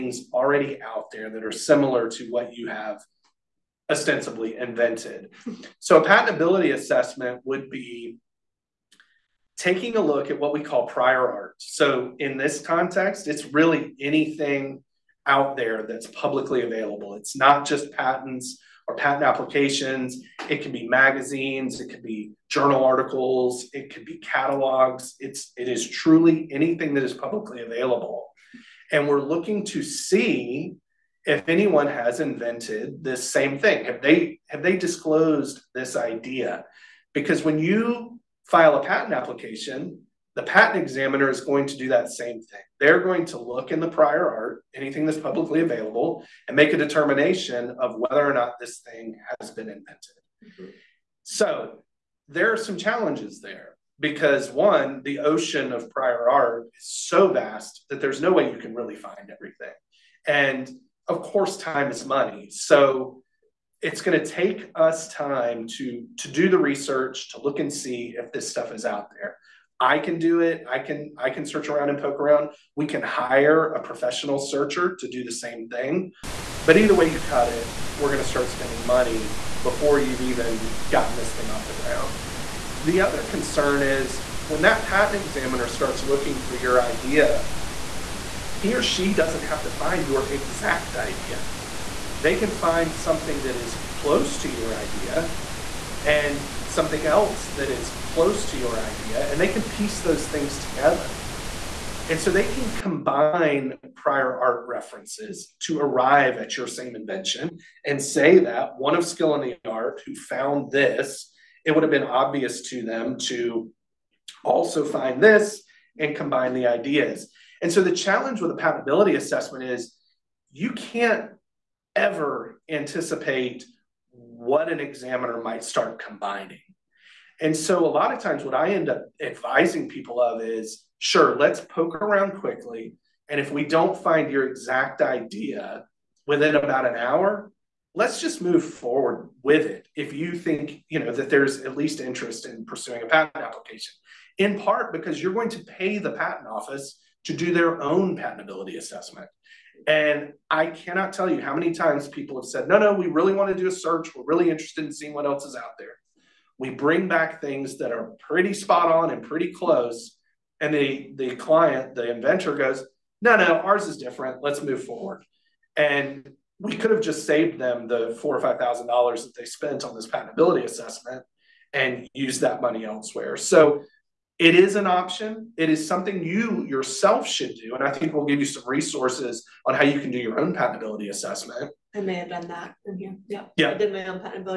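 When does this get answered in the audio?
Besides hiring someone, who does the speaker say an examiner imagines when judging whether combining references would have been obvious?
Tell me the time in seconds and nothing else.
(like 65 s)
108 s.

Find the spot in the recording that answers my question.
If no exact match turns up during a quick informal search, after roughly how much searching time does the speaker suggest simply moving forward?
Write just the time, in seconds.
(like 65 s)
136 s.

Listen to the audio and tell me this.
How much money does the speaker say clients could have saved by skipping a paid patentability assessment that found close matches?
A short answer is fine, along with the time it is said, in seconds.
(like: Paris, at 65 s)
$4,000 to $5,000, at 168 s.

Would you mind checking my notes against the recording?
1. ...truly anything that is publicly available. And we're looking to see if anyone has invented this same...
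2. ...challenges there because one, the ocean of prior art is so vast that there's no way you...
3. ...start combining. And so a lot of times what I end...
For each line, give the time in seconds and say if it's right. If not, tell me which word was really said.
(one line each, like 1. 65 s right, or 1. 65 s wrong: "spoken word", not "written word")
1. 25 s right
2. 52 s right
3. 125 s right.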